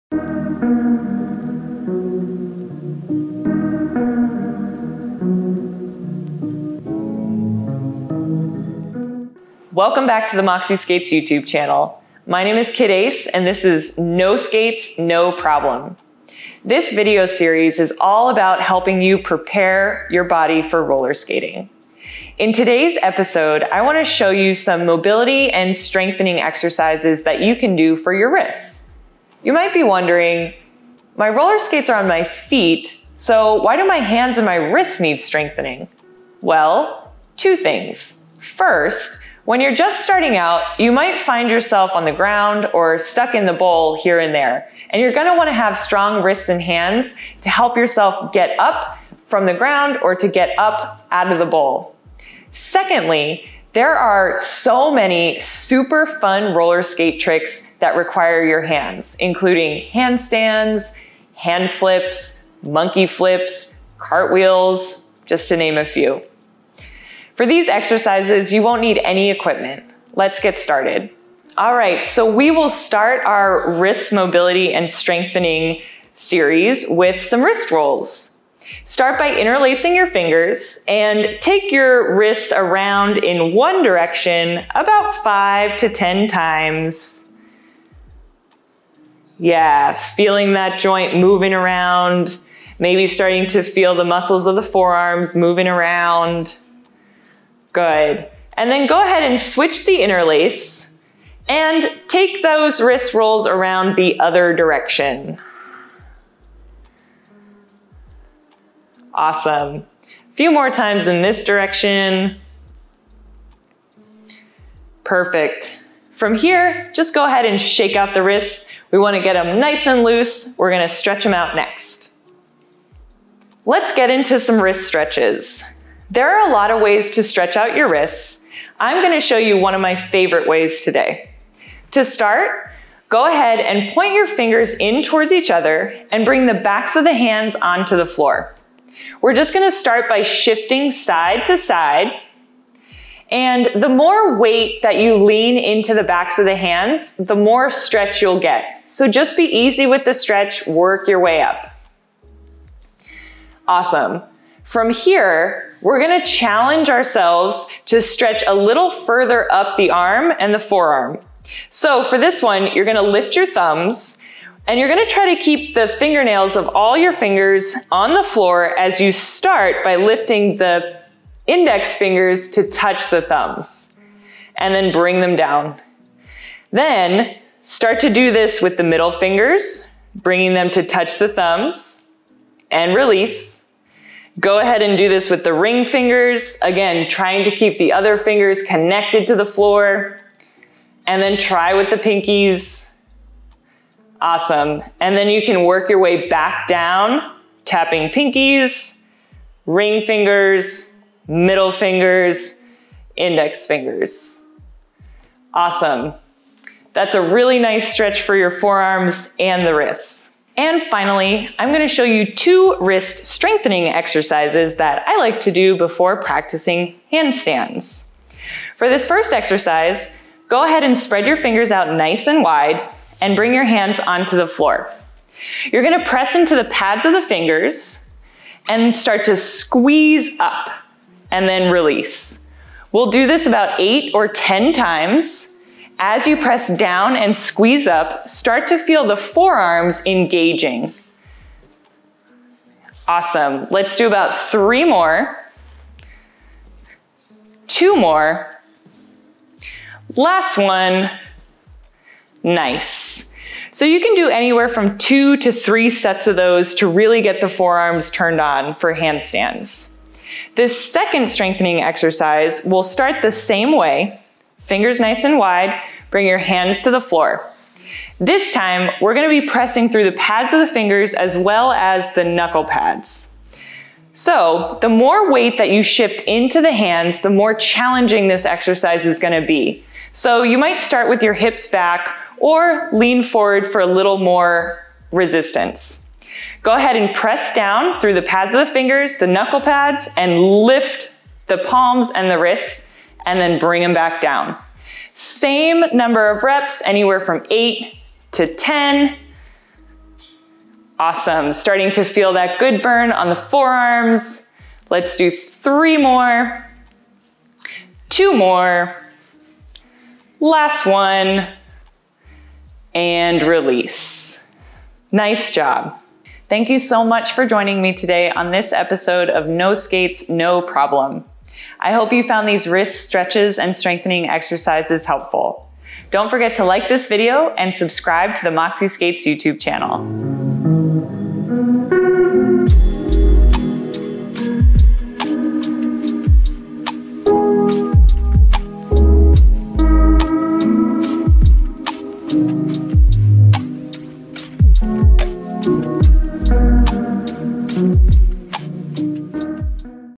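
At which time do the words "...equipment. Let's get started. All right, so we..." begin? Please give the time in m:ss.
1:09.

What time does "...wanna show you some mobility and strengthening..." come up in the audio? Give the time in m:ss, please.
0:23.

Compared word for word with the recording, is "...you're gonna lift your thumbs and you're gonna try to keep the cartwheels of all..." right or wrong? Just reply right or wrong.
wrong.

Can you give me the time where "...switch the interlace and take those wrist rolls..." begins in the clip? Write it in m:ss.
1:39.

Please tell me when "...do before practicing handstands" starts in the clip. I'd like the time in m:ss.
3:35.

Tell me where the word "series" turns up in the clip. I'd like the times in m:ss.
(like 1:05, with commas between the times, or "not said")
0:17, 1:16.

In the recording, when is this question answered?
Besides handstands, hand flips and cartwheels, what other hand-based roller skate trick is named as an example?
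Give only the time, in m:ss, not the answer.
1:02.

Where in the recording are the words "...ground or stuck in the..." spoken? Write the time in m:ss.
0:42.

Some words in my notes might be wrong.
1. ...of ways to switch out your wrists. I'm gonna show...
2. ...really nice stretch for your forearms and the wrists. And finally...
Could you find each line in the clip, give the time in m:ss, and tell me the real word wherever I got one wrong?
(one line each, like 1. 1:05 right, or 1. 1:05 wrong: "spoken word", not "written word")
1. 2:06 wrong: "stretch", not "switch"
2. 3:27 right.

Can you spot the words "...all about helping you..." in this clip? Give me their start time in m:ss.
0:17.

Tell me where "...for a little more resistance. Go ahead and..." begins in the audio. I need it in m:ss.
4:43.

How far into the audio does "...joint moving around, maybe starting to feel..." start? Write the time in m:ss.
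1:30.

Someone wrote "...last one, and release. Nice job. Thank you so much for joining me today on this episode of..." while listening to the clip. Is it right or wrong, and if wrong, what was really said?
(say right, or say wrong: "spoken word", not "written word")
right.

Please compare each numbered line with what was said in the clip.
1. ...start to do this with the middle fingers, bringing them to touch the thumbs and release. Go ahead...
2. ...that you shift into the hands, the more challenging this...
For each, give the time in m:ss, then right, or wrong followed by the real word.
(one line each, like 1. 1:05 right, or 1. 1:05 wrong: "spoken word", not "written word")
1. 2:57 right
2. 4:35 right.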